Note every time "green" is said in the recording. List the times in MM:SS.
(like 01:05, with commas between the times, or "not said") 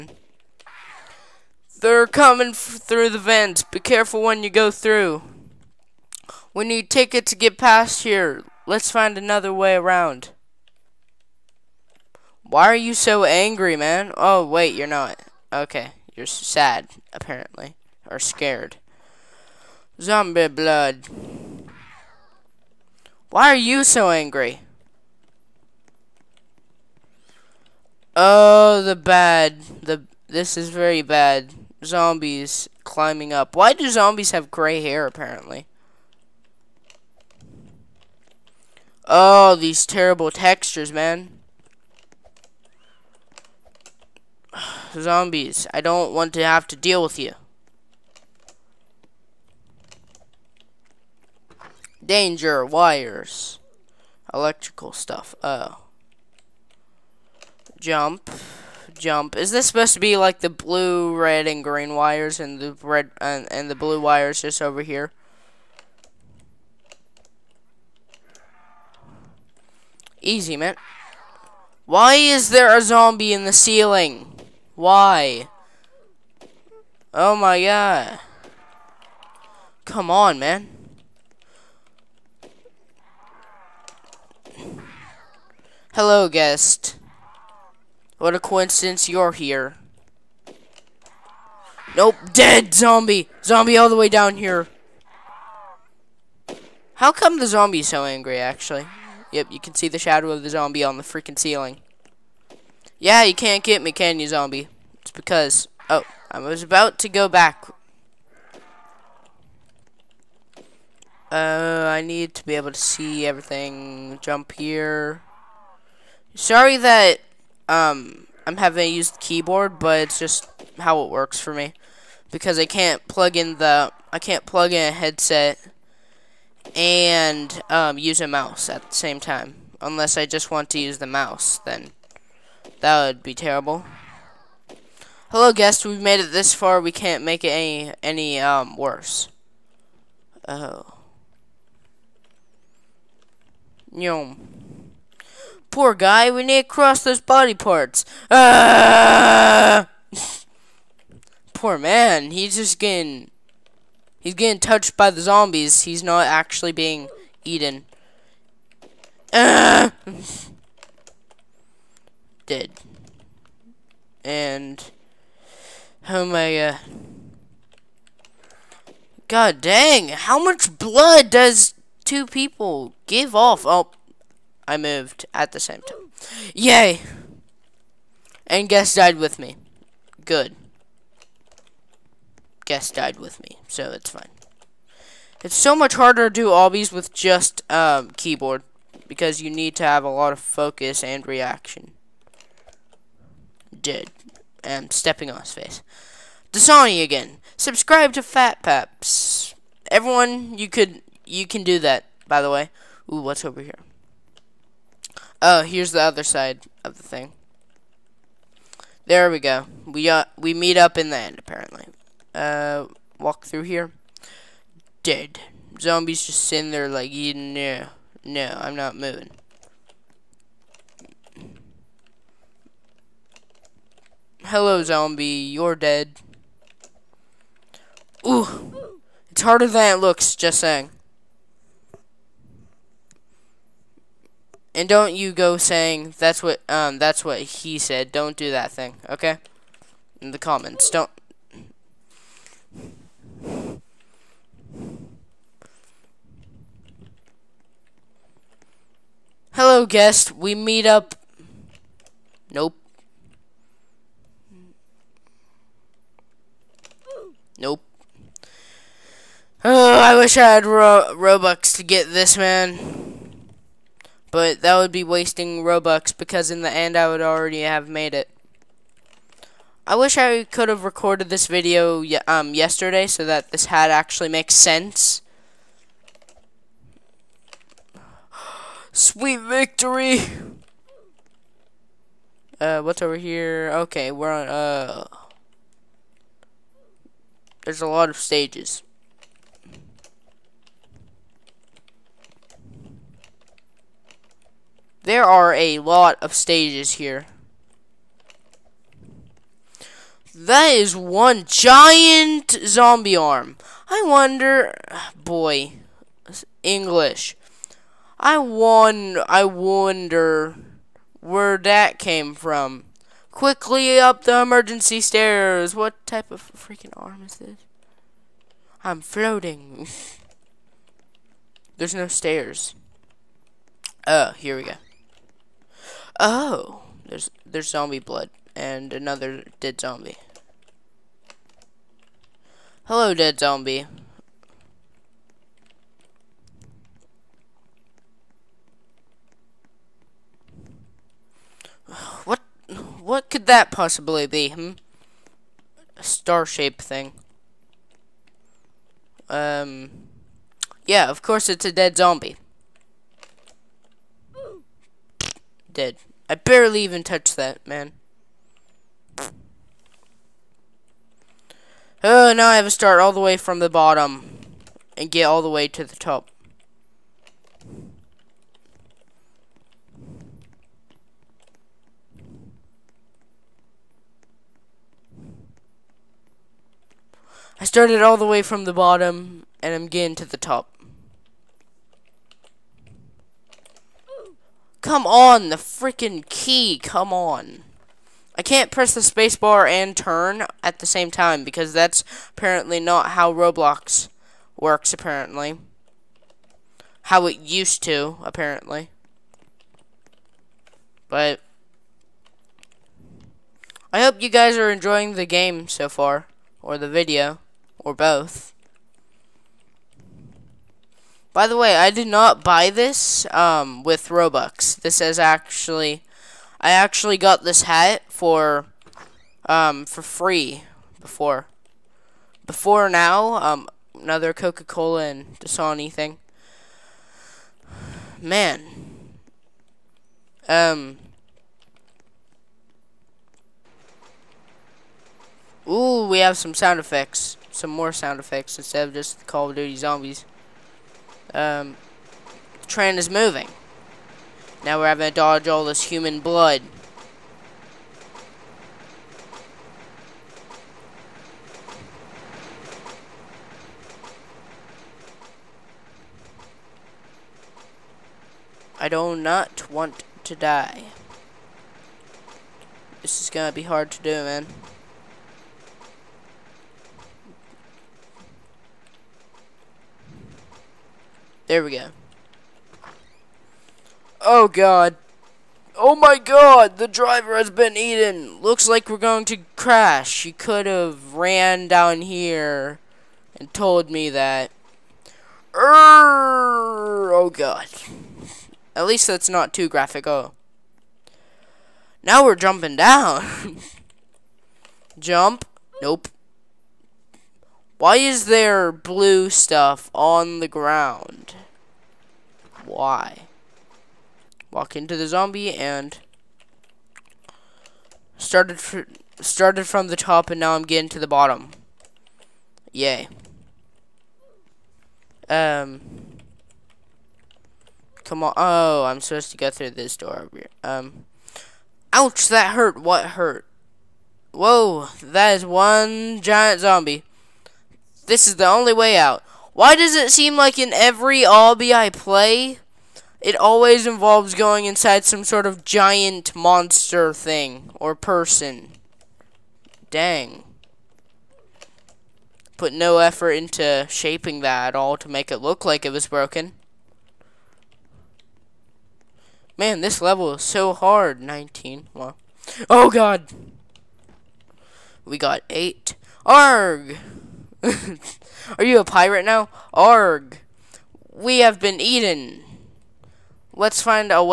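01:01.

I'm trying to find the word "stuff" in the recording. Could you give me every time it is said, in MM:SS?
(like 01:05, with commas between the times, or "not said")
00:54, 08:19.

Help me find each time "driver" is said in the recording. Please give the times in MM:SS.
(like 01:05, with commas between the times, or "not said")
07:56.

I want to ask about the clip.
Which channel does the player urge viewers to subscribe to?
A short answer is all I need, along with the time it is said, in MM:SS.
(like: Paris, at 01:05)
Fat Paps, at 03:18.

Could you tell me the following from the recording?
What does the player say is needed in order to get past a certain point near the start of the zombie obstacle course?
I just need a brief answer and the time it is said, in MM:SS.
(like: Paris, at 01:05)
Tickets, at 00:06.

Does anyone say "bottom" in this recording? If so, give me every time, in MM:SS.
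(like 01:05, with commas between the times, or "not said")
06:03, 06:18, 08:31.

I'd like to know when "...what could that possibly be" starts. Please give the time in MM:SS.
05:42.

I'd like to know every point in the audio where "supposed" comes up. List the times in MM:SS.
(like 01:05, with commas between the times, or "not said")
00:59, 08:38.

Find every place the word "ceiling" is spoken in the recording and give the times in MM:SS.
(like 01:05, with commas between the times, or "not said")
01:13, 01:41.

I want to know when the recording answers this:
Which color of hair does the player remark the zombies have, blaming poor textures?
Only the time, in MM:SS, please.
00:34.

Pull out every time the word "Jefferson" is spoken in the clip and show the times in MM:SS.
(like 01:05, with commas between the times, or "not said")
not said.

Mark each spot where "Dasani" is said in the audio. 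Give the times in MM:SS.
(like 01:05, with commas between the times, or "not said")
03:16, 07:05.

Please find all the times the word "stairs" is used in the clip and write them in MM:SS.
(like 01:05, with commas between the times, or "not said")
05:14, 05:22.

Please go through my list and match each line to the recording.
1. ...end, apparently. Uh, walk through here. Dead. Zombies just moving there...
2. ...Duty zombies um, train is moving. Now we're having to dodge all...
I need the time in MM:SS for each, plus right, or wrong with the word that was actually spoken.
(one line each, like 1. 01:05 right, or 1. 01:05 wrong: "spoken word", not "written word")
1. 03:31 wrong: "sitting", not "moving"
2. 07:19 right.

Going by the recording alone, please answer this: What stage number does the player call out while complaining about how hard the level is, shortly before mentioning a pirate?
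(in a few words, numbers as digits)
19.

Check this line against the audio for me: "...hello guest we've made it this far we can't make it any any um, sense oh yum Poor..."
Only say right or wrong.
wrong.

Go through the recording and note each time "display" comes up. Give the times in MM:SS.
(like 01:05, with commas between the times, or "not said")
not said.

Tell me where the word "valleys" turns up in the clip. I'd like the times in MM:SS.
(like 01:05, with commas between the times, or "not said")
not said.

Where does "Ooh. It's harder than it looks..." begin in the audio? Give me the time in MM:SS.
03:48.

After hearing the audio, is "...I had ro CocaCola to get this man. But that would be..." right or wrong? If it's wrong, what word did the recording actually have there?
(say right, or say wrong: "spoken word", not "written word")
wrong: "Robux", not "CocaCola".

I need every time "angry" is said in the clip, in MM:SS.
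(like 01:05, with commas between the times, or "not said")
00:13, 00:24, 01:38.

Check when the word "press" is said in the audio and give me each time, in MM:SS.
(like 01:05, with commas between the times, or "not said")
06:28.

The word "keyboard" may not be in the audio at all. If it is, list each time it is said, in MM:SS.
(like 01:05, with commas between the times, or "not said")
01:59, 03:08.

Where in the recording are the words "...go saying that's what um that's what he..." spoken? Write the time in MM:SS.
03:55.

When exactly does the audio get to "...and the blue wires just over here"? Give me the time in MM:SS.
01:03.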